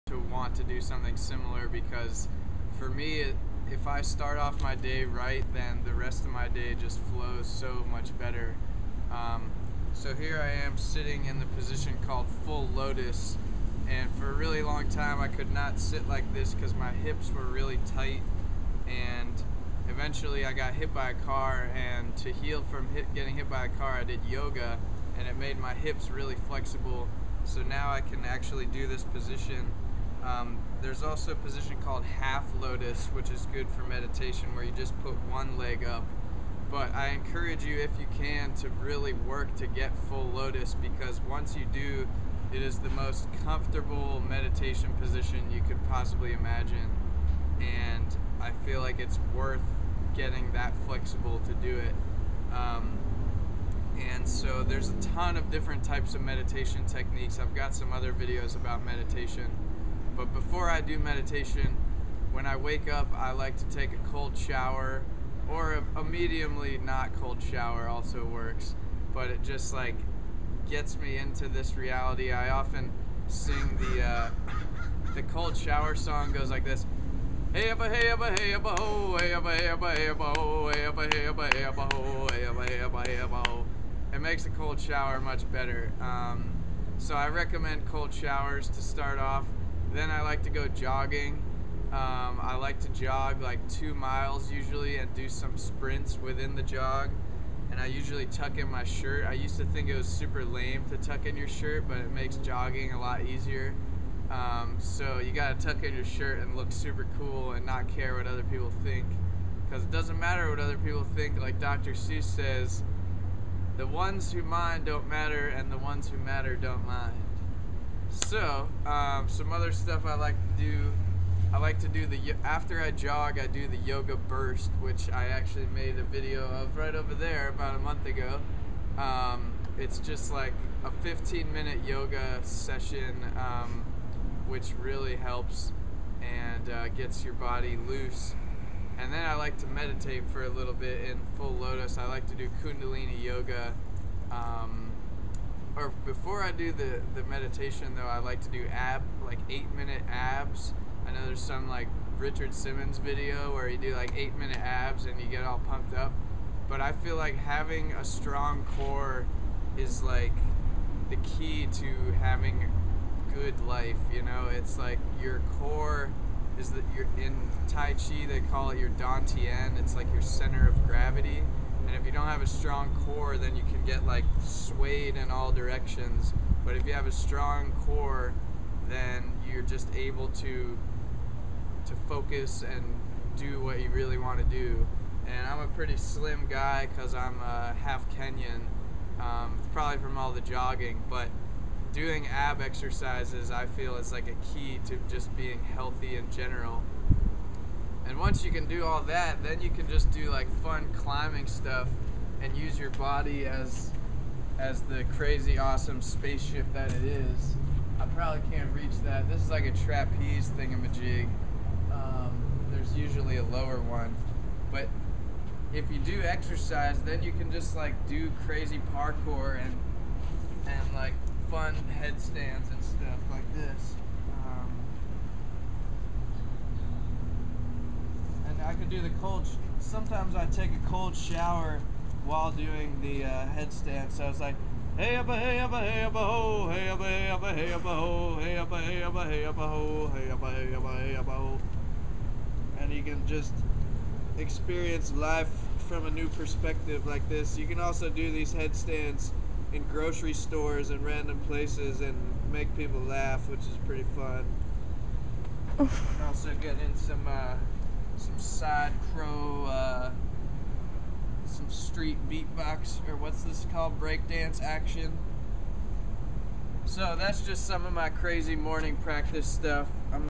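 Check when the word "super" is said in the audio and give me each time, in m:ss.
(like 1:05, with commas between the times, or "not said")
1:40, 1:46.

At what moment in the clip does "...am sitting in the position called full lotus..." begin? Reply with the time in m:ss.
0:10.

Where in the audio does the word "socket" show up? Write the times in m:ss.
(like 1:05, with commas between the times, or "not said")
not said.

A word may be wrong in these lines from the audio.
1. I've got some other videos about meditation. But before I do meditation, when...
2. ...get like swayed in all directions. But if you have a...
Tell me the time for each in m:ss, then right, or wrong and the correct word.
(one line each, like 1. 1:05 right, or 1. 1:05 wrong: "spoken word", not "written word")
1. 0:57 right
2. 2:53 right.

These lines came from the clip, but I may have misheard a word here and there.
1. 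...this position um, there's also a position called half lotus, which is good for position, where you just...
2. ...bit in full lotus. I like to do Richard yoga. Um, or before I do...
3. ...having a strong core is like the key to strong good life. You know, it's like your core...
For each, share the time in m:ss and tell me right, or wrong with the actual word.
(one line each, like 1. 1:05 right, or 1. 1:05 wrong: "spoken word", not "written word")
1. 0:28 wrong: "meditation", not "position"
2. 2:20 wrong: "Kundalini", not "Richard"
3. 2:37 wrong: "having", not "strong".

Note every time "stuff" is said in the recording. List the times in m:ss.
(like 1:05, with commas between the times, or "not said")
1:59, 3:21, 3:42, 4:29.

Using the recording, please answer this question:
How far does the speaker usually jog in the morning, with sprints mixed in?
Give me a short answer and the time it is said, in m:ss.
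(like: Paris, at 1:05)
2 miles, at 1:33.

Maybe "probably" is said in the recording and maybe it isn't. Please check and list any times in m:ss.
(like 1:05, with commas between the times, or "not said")
3:09, 3:28.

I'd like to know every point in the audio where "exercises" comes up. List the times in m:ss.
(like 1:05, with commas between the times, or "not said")
3:12, 3:36.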